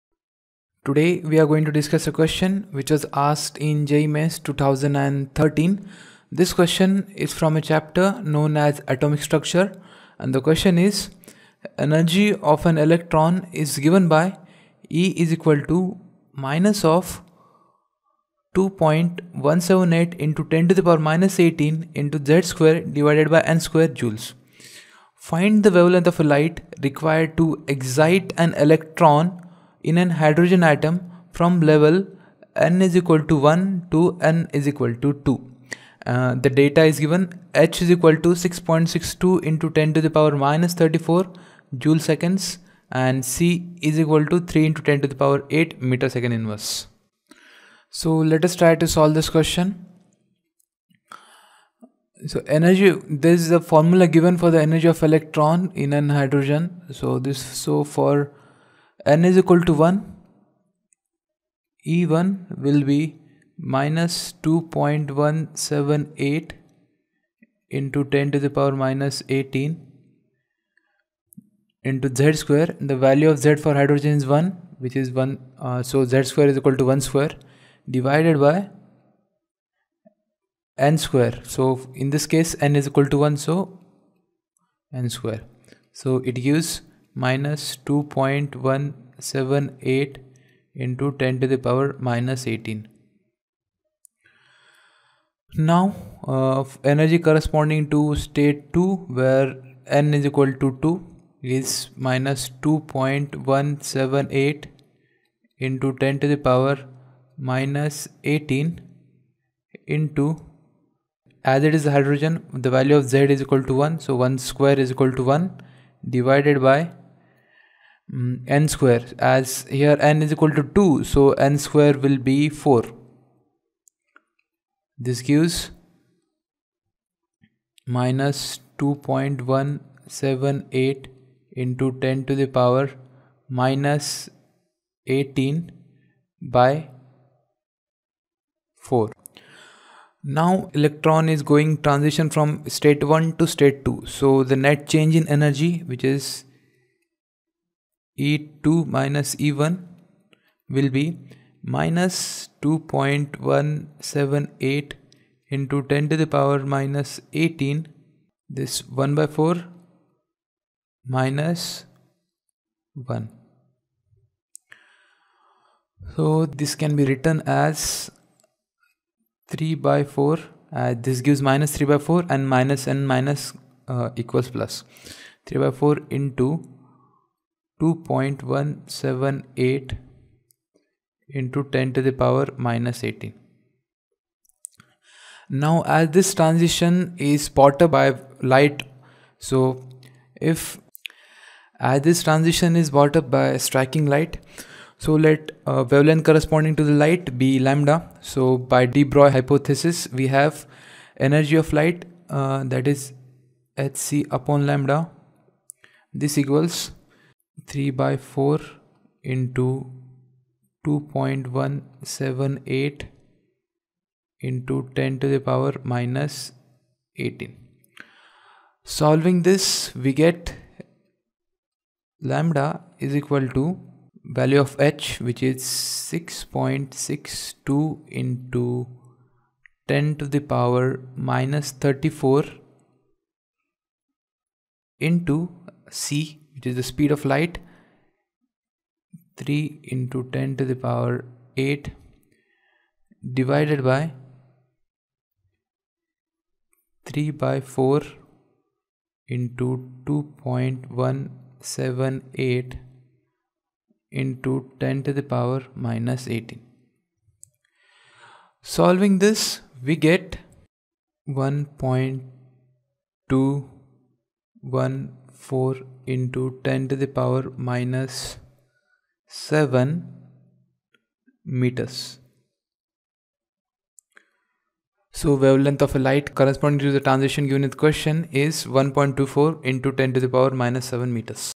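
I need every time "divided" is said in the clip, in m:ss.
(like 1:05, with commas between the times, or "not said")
0:22, 1:17, 1:56, 4:03.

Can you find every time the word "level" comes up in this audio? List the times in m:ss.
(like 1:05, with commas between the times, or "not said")
0:31.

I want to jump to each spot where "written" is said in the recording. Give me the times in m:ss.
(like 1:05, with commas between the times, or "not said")
2:47.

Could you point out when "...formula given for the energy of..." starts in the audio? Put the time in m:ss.
0:53.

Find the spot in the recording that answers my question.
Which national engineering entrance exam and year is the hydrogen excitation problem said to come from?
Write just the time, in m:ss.
0:03.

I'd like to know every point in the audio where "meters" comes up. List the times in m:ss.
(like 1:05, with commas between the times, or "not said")
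0:45, 4:31, 4:41.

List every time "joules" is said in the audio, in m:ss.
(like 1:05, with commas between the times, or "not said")
0:23, 0:41.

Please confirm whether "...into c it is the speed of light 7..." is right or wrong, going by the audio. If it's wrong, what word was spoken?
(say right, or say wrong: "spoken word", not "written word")
wrong: "3", not "7".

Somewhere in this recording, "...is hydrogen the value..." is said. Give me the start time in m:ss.
1:51.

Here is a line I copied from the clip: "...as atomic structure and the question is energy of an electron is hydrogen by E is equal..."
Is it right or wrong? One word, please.
wrong.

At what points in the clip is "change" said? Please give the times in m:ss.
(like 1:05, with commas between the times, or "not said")
2:24.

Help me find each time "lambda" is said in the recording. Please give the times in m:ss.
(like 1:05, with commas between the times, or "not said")
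3:17, 3:24, 3:42.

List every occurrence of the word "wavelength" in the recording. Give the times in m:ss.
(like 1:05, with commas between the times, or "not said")
0:25, 3:15, 4:35.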